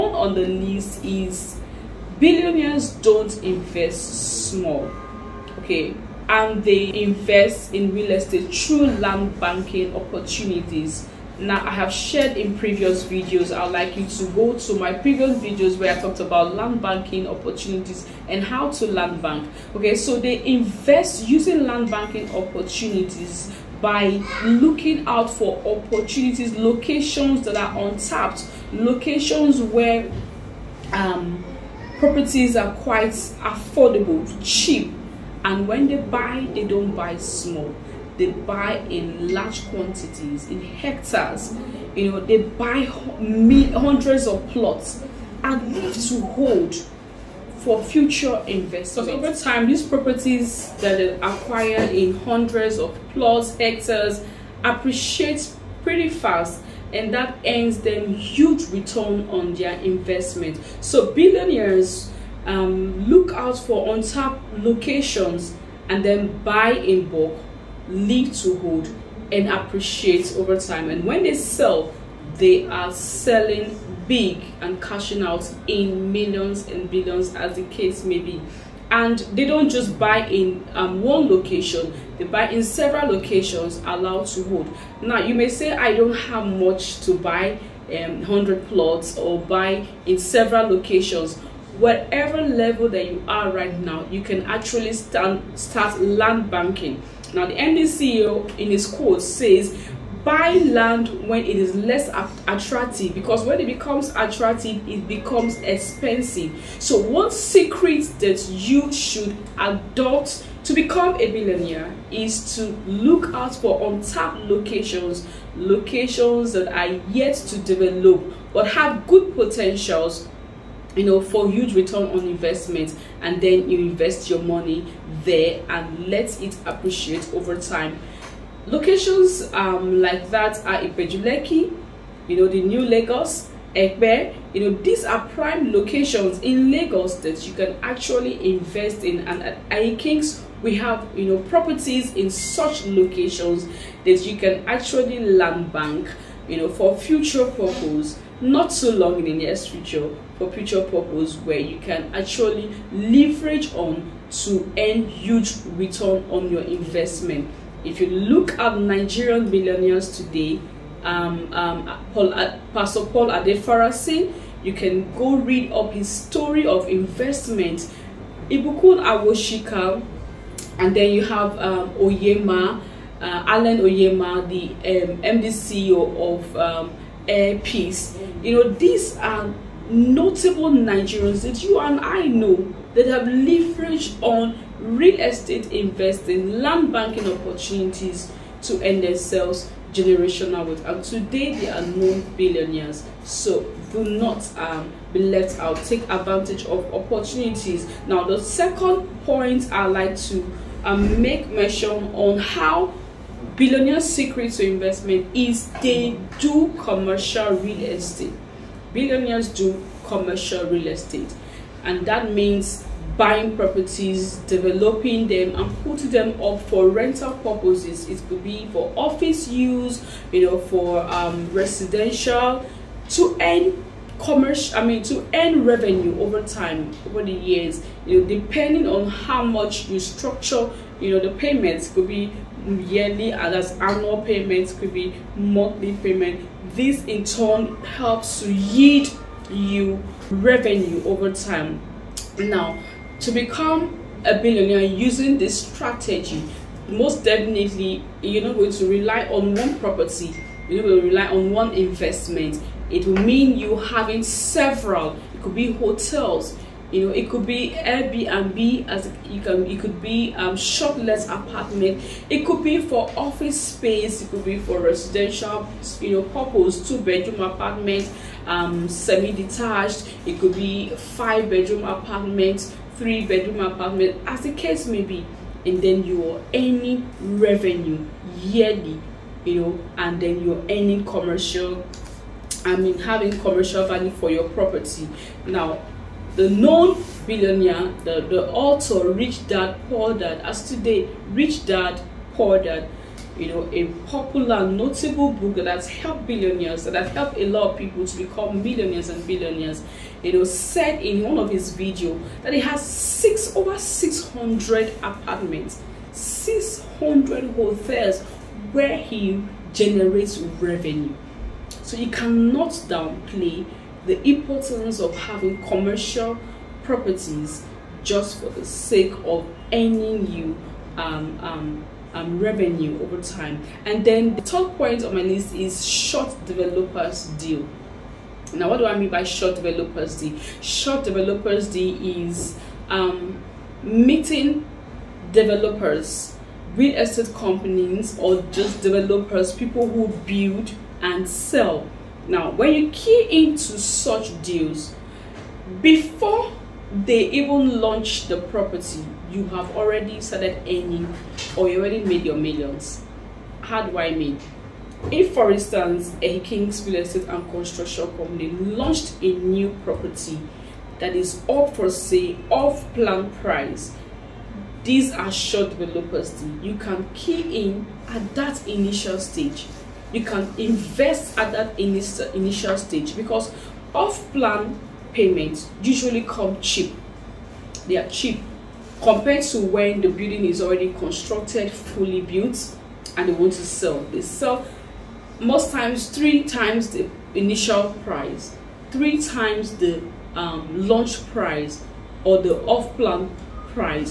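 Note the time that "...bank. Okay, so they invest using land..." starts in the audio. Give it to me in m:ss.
0:19.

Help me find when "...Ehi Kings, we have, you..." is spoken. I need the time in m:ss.
2:19.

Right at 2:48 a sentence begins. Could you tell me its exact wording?
Ibukun Awosika, and then you have um, Onyema, uh, Allen Onyema, the um, CEO of um, Air Peace.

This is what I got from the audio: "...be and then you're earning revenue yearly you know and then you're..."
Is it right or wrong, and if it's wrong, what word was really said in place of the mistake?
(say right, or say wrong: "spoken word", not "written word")
right.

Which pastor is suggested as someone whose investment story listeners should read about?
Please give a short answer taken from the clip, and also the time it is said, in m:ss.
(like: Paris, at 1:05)
Paul Adefarasin, at 2:42.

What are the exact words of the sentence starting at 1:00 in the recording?
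So billionaires um, look out for untapped locations and then buy in bulk, live to hold and appreciate over time.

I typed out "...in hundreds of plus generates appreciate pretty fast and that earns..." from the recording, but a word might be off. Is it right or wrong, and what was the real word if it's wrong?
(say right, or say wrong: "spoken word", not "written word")
wrong: "hectares", not "generates".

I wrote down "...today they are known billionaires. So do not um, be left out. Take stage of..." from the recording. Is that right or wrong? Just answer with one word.
wrong.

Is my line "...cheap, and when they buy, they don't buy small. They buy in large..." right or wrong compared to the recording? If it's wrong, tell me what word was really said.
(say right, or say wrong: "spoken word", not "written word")
right.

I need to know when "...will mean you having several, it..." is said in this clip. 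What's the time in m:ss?
4:13.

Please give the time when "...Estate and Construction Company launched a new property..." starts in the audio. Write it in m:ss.
5:56.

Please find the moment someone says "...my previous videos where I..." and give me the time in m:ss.
0:14.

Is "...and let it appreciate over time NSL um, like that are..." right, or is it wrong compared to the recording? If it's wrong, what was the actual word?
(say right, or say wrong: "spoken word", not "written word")
wrong: "Locations", not "NSL".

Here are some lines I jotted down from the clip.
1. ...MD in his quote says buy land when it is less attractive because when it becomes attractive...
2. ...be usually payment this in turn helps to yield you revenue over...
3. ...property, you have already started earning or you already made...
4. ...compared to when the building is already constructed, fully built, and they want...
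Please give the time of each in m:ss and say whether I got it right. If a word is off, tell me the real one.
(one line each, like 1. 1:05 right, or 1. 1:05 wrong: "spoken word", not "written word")
1. 1:37 right
2. 3:54 wrong: "monthly", not "usually"
3. 5:48 right
4. 6:19 right.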